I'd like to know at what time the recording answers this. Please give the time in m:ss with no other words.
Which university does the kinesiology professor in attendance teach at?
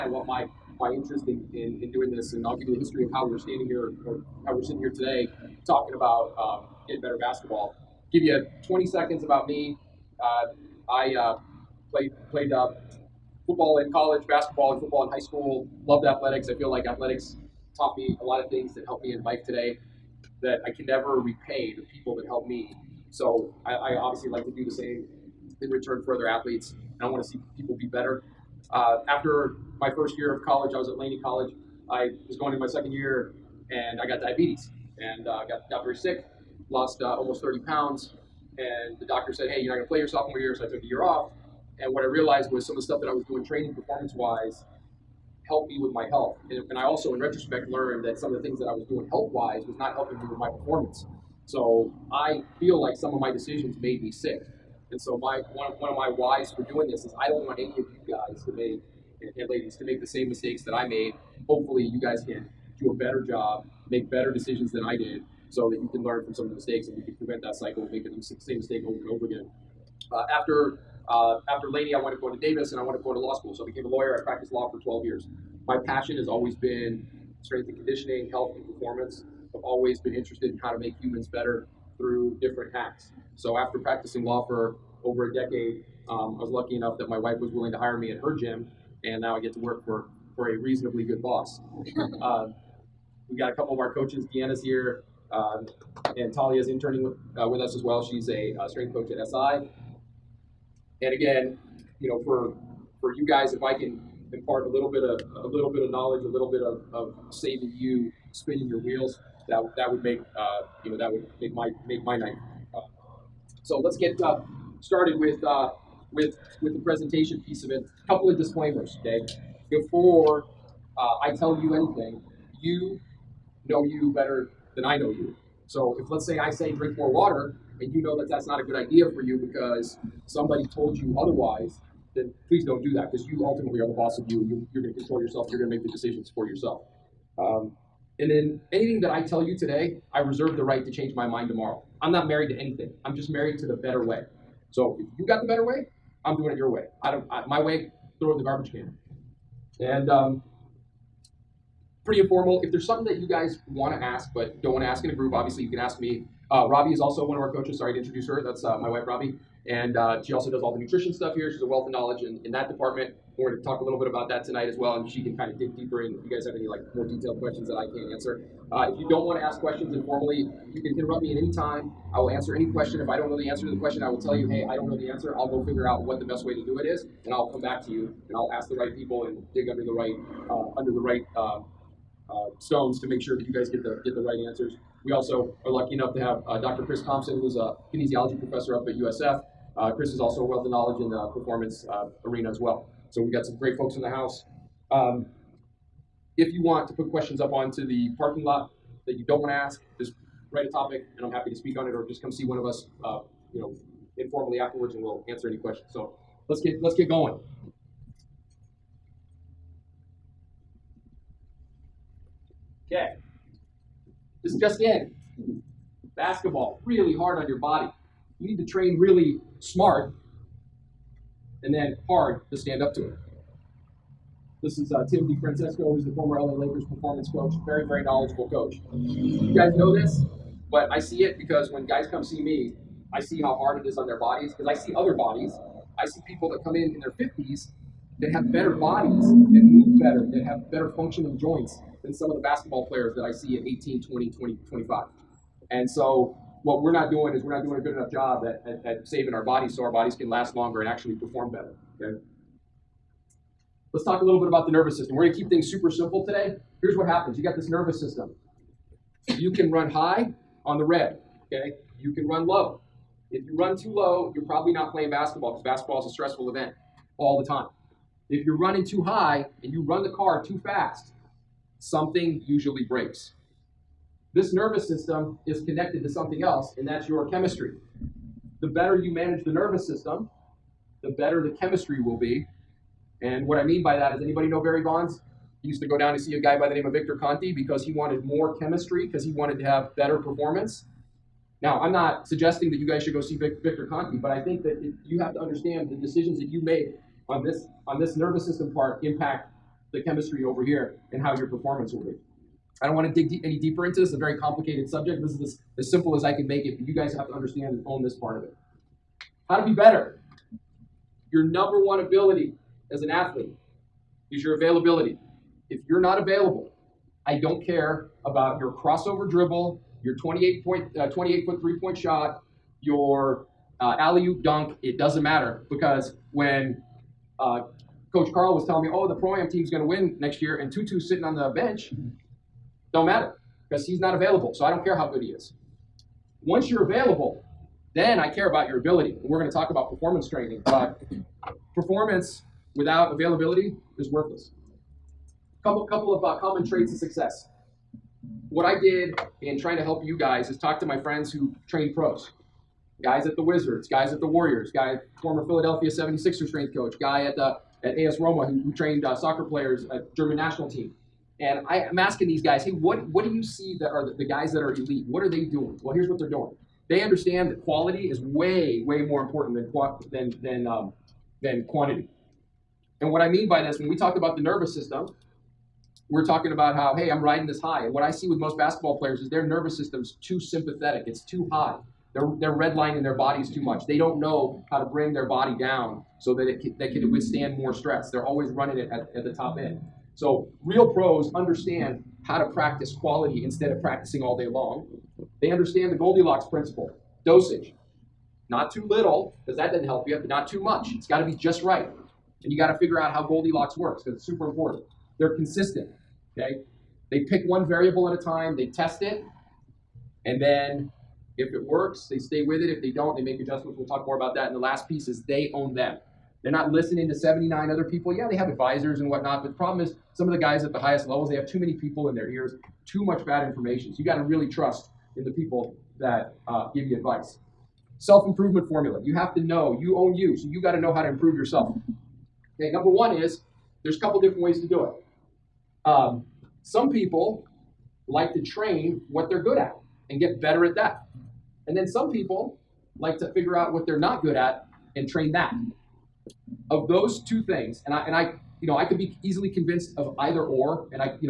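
3:08.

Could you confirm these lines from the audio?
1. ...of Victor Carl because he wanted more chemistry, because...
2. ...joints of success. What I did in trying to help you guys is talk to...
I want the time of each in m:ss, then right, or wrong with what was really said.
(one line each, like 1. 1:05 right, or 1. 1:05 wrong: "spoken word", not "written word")
1. 4:46 wrong: "Conte", not "Carl"
2. 5:46 wrong: "traits", not "joints".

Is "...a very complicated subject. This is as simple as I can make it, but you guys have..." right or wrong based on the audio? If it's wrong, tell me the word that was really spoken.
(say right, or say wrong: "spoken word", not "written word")
right.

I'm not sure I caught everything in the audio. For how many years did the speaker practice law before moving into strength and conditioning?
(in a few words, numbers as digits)
12.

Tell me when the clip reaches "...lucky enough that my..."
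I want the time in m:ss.
1:26.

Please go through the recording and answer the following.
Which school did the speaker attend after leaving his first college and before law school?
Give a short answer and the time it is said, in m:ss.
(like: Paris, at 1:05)
Davis, at 1:12.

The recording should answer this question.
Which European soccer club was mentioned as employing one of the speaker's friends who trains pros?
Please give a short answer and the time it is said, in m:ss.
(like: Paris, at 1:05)
AS Roma, at 5:57.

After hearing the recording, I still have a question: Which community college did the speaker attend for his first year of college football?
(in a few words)
Laney College.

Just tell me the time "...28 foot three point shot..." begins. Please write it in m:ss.
5:21.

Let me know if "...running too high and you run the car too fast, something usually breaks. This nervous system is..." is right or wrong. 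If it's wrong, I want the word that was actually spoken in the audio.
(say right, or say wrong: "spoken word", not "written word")
right.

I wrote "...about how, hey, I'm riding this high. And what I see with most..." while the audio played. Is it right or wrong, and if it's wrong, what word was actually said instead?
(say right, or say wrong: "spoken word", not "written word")
right.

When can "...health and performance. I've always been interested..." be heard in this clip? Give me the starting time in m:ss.
1:18.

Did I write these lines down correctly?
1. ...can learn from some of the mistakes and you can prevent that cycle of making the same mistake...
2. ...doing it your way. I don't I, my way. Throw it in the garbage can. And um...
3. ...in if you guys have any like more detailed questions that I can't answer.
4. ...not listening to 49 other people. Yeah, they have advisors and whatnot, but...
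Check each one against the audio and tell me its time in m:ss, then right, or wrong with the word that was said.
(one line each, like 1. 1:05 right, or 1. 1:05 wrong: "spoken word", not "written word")
1. 1:05 right
2. 2:26 right
3. 2:46 right
4. 6:56 wrong: "79", not "49".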